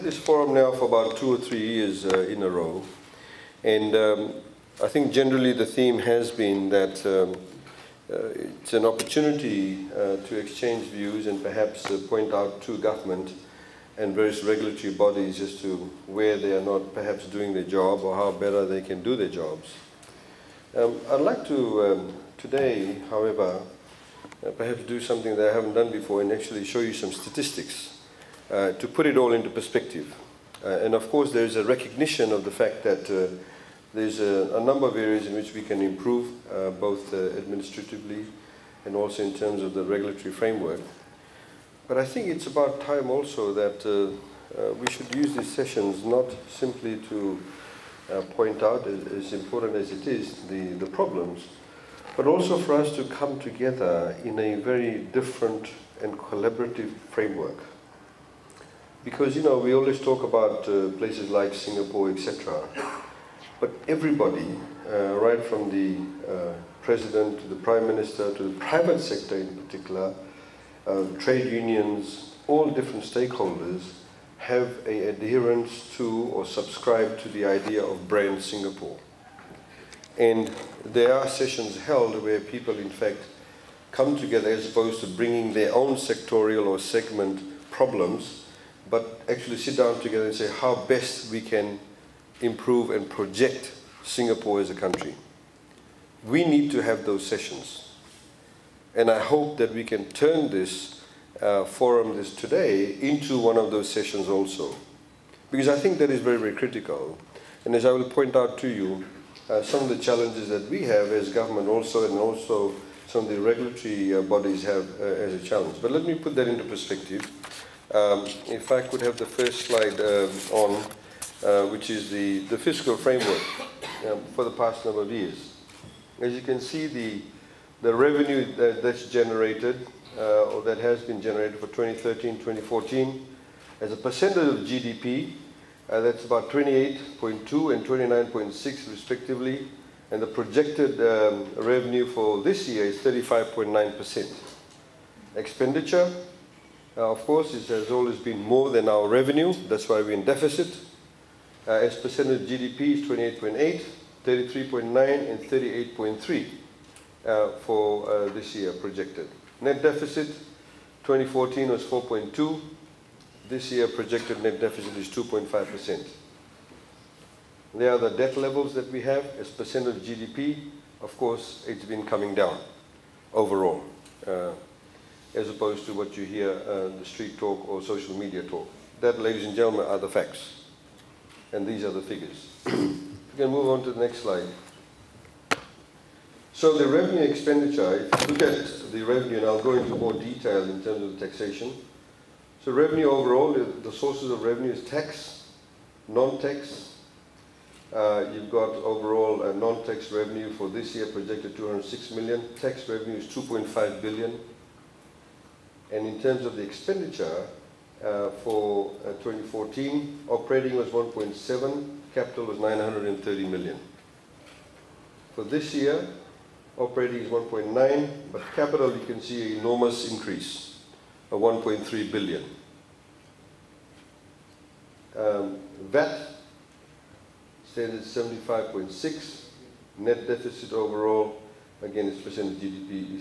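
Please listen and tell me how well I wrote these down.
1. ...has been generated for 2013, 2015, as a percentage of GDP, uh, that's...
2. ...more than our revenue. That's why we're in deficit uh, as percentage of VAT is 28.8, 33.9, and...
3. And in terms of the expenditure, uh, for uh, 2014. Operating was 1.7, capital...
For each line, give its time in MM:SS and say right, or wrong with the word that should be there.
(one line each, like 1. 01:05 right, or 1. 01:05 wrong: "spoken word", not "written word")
1. 02:10 wrong: "2014", not "2015"
2. 02:28 wrong: "GDP", not "VAT"
3. 03:25 right.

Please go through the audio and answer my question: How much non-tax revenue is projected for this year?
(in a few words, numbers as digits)
206 million.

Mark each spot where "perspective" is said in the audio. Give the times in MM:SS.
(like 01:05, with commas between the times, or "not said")
00:29, 01:56.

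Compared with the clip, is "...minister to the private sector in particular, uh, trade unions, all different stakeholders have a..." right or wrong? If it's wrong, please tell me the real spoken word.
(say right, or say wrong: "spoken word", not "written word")
right.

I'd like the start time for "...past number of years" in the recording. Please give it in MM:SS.
02:04.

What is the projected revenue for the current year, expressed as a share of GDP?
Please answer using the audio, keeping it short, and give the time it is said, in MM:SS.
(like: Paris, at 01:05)
35.9%, at 02:22.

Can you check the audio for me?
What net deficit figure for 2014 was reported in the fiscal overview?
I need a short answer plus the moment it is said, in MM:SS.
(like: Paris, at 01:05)
4.2, at 02:41.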